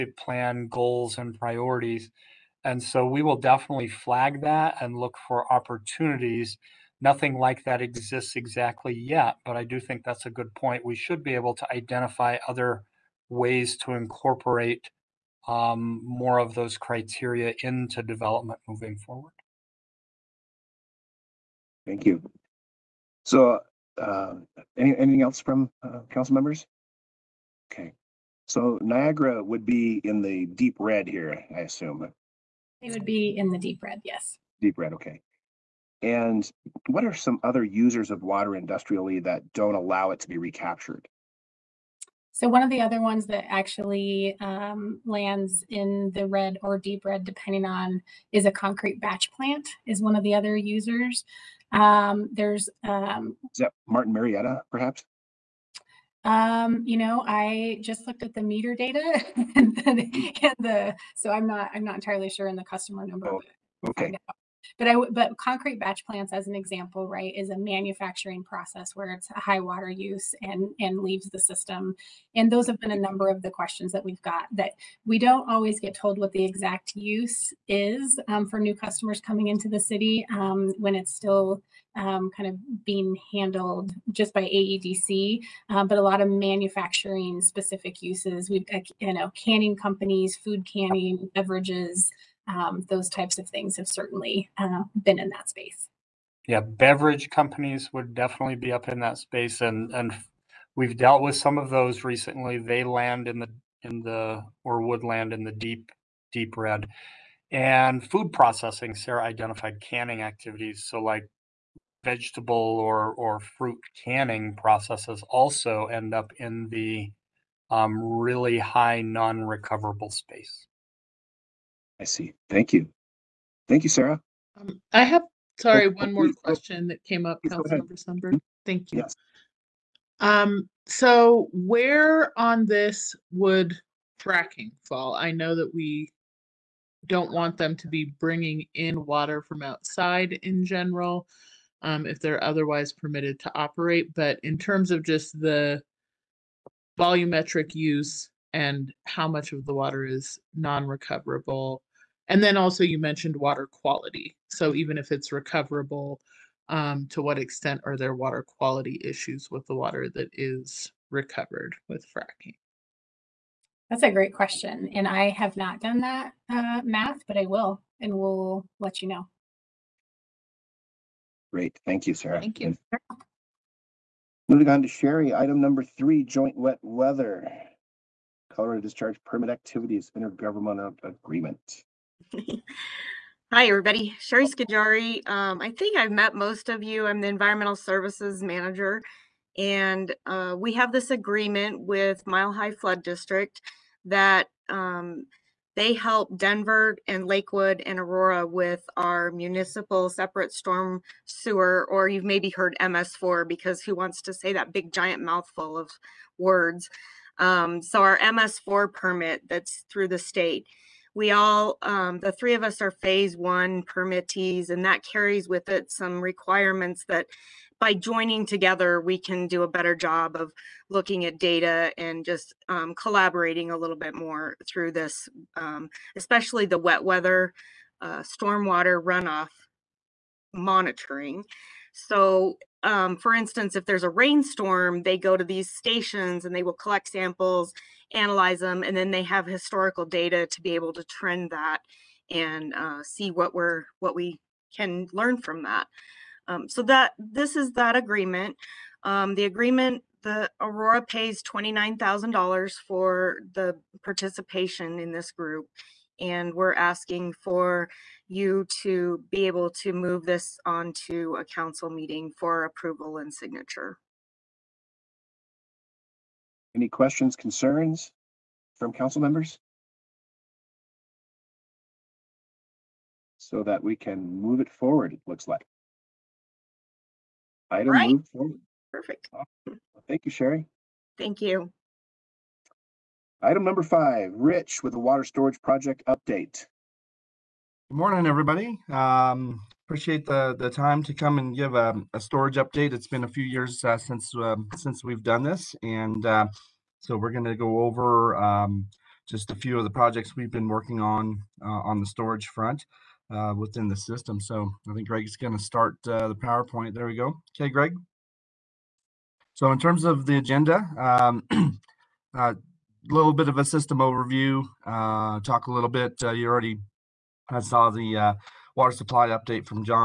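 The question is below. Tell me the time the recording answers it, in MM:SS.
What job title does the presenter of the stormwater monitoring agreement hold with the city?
03:07.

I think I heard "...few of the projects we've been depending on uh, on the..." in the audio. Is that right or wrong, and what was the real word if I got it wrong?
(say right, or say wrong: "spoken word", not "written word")
wrong: "working", not "depending".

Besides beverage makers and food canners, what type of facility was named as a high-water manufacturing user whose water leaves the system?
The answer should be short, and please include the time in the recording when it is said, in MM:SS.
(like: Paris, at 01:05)
concrete batch plant, at 00:48.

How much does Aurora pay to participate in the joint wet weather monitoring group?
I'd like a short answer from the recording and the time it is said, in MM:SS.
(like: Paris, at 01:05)
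$29,000, at 04:11.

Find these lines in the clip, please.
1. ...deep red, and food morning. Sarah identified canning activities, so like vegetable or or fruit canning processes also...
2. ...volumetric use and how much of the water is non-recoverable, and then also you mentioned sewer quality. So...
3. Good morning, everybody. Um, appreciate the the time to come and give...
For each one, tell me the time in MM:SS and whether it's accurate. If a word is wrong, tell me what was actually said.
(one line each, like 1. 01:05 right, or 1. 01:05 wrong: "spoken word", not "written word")
1. 01:46 wrong: "processing", not "morning"
2. 02:26 wrong: "water", not "sewer"
3. 04:47 right.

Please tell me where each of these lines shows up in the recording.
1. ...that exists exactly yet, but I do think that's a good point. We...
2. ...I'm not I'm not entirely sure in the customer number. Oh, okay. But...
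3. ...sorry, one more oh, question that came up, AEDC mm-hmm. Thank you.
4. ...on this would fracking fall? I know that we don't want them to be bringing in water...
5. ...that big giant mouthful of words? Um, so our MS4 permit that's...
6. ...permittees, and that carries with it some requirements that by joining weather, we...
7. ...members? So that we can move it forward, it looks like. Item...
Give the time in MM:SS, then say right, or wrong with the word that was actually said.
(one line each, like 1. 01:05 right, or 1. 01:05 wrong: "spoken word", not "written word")
1. 00:07 right
2. 01:01 right
3. 02:05 wrong: "Councilmember", not "AEDC"
4. 02:12 right
5. 03:24 right
6. 03:33 wrong: "together", not "weather"
7. 04:29 right.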